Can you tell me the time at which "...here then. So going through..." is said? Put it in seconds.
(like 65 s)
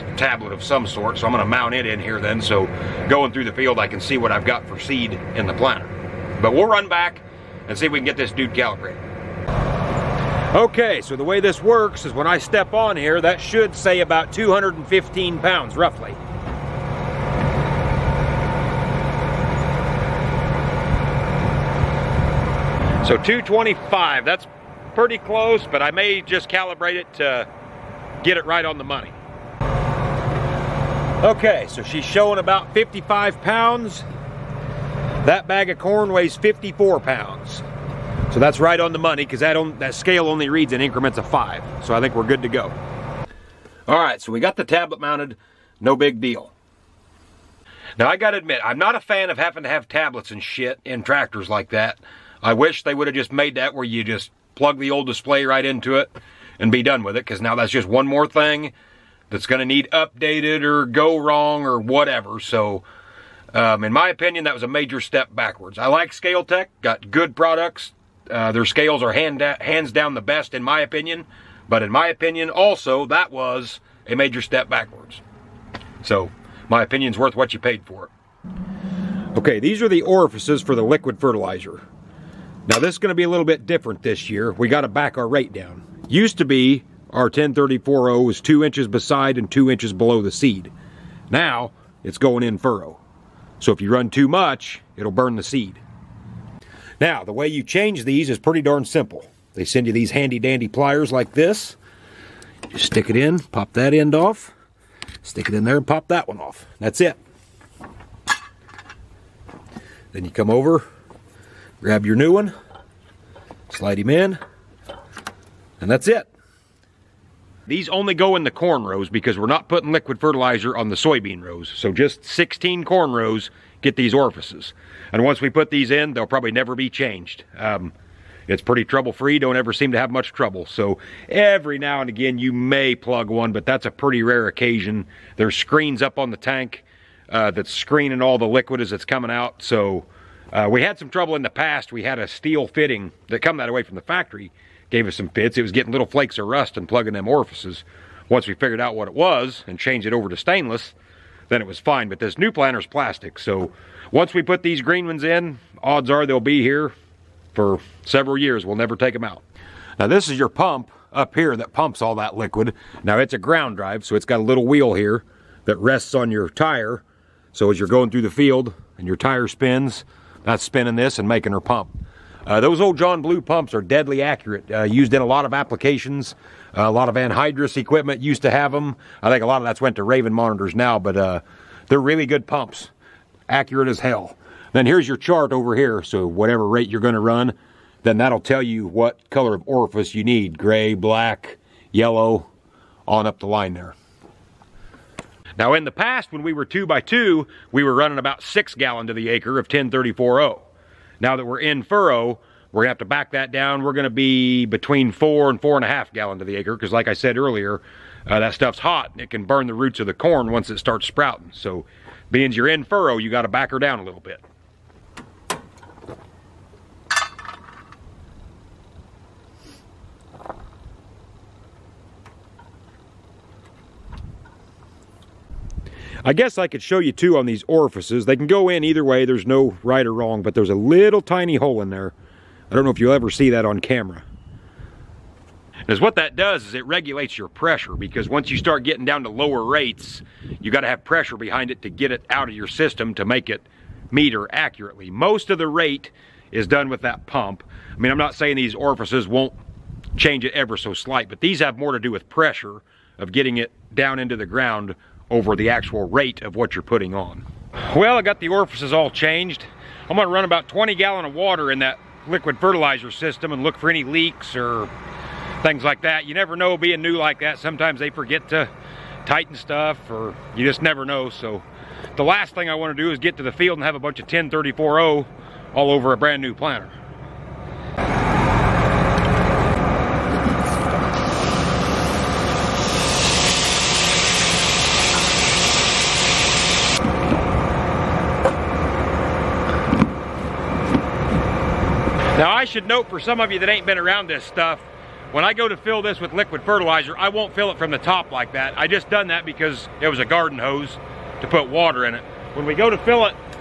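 1 s.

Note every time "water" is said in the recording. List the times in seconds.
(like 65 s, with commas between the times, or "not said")
261 s, 301 s.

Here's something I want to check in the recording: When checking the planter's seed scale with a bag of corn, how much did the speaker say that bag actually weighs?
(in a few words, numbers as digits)
54 pounds.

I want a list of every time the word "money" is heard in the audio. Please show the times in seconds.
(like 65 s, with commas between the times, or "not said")
28 s, 38 s.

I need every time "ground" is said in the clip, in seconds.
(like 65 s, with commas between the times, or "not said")
163 s, 254 s.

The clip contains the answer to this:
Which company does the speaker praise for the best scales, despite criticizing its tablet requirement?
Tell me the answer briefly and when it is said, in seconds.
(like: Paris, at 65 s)
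Scale-Tec, at 66 s.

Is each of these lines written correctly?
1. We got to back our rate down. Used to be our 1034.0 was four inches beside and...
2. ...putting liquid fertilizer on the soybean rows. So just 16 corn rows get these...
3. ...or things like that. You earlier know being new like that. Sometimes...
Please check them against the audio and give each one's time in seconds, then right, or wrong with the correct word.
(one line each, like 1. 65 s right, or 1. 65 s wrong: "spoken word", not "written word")
1. 84 s wrong: "two", not "four"
2. 119 s right
3. 264 s wrong: "never", not "earlier".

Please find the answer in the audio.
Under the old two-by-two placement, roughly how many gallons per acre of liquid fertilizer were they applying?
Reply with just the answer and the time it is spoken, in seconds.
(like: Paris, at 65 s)
6 gallons, at 198 s.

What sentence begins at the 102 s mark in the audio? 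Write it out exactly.
Just stick it in, pop that end off, stick it in there and pop that one off.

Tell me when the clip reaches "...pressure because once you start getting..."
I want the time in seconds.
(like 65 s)
237 s.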